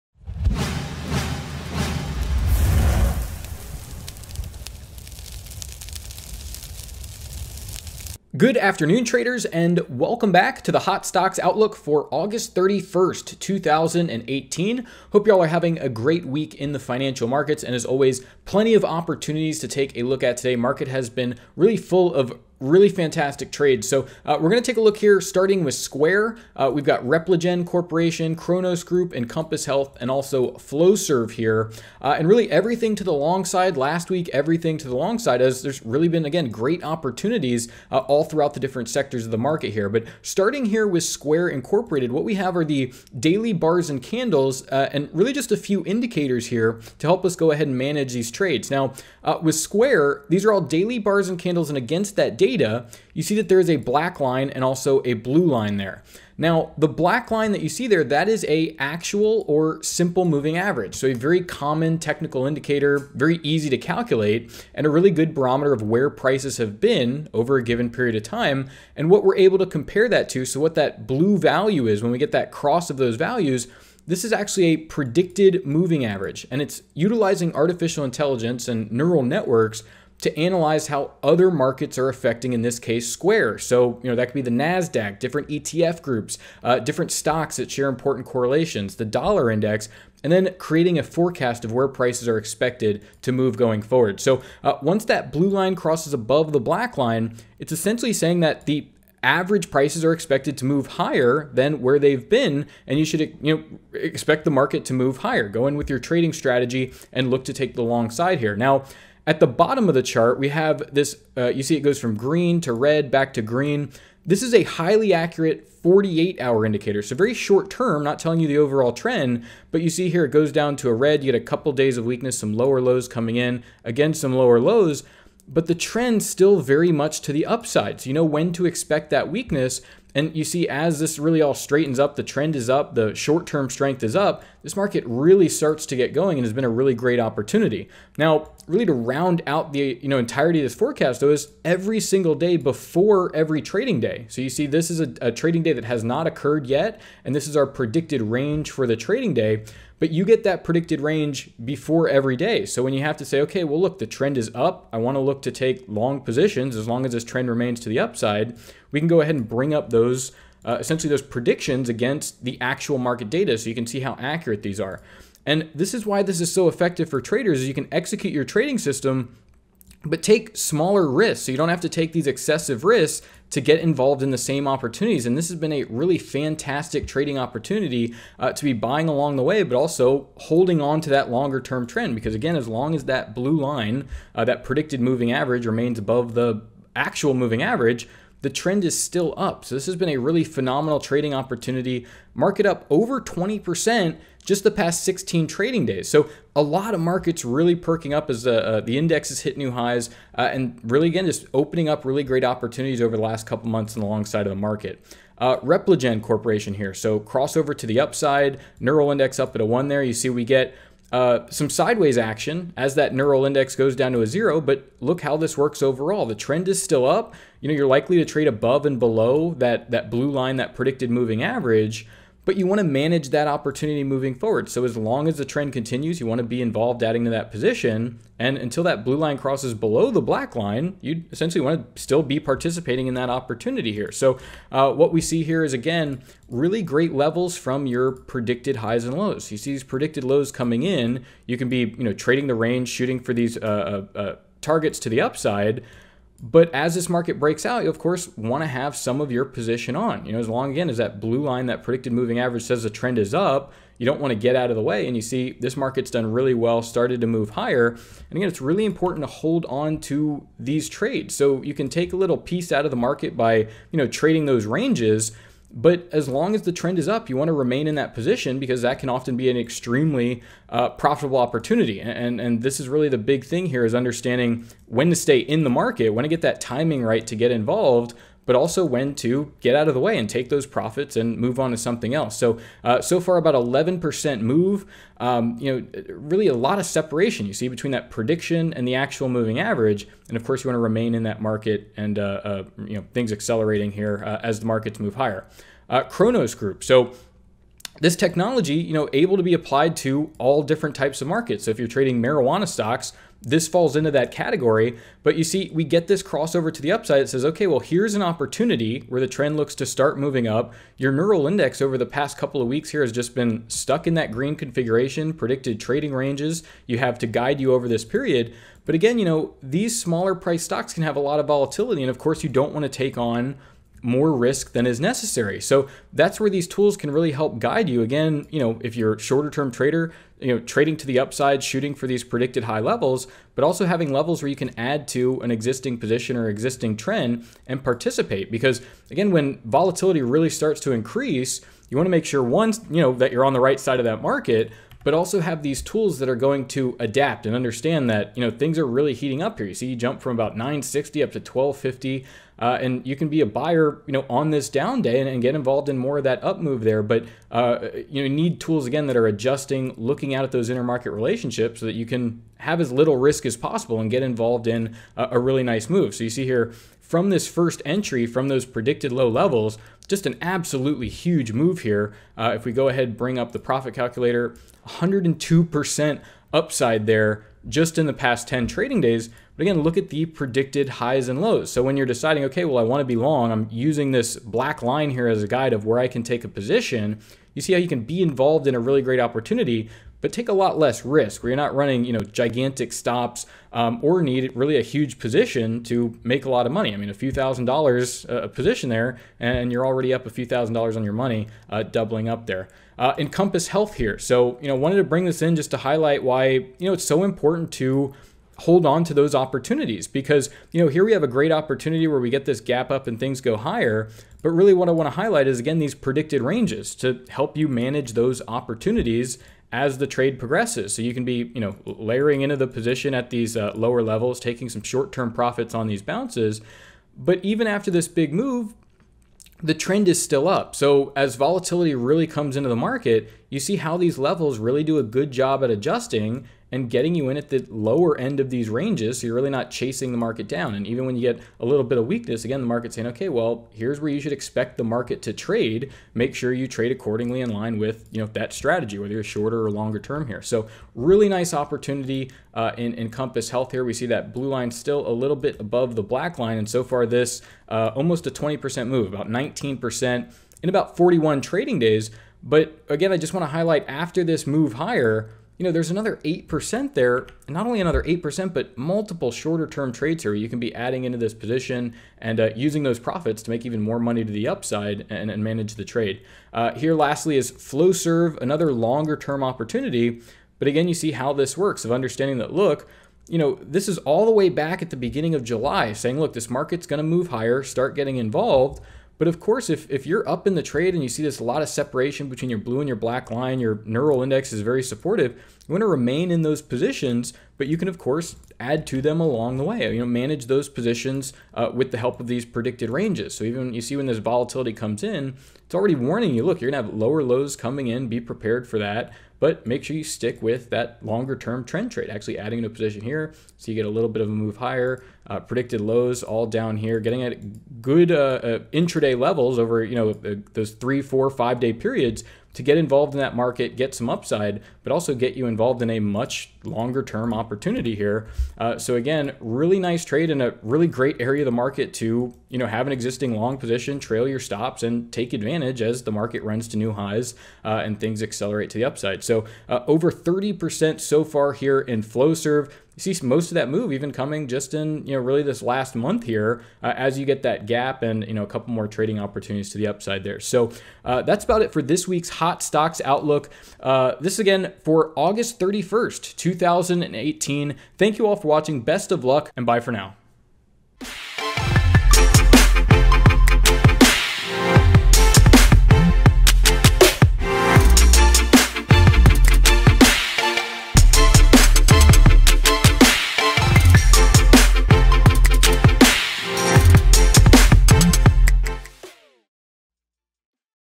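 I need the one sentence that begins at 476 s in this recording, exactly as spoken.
Uh, here, lastly, is Flowserve, another longer term opportunity.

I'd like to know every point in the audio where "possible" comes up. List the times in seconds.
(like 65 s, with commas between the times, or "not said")
363 s.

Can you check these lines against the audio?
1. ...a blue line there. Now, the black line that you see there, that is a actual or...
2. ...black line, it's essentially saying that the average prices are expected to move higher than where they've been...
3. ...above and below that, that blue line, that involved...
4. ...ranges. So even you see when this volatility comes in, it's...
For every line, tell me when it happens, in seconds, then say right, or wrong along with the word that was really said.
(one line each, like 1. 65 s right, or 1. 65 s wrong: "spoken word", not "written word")
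1. 55 s right
2. 96 s right
3. 218 s wrong: "predicted", not "involved"
4. 502 s right.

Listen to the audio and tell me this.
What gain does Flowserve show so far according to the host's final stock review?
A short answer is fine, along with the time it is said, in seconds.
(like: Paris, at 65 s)
Over 30%, at 539 s.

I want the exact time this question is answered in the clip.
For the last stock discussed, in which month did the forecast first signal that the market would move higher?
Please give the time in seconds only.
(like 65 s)
485 s.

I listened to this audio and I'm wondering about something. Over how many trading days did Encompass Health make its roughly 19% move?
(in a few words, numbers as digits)
41.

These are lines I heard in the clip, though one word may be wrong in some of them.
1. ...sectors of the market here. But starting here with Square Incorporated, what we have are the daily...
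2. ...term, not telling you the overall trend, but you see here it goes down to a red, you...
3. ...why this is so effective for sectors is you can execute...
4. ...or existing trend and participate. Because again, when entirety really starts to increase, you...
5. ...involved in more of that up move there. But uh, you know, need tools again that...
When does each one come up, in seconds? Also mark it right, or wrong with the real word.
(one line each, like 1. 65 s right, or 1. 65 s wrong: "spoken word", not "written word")
1. 38 s right
2. 117 s right
3. 166 s wrong: "traders", not "sectors"
4. 336 s wrong: "volatility", not "entirety"
5. 355 s right.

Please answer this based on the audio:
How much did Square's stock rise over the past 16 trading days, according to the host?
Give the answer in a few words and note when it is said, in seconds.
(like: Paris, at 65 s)
Over 20%, at 192 s.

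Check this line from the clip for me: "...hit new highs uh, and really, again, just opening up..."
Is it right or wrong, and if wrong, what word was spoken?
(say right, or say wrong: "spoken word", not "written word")
right.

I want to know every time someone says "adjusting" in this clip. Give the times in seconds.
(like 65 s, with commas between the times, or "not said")
359 s, 435 s.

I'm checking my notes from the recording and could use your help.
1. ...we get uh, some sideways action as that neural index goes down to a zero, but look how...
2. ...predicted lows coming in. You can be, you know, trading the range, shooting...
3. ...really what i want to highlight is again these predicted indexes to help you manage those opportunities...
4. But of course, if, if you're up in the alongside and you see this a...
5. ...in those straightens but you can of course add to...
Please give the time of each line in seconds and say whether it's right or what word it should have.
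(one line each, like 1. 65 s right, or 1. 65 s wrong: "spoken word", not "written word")
1. 210 s right
2. 239 s right
3. 414 s wrong: "ranges", not "indexes"
4. 489 s wrong: "trade", not "alongside"
5. 496 s wrong: "positions", not "straightens".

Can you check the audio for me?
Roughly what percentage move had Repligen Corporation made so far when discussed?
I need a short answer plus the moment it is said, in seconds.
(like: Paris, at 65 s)
11%, at 283 s.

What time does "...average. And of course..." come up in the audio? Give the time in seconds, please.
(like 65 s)
289 s.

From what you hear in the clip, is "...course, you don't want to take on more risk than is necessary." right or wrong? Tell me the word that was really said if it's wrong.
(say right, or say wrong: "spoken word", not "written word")
right.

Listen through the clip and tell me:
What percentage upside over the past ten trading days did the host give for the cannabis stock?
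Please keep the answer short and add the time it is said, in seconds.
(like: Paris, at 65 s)
102%, at 374 s.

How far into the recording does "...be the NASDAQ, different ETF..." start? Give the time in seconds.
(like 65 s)
84 s.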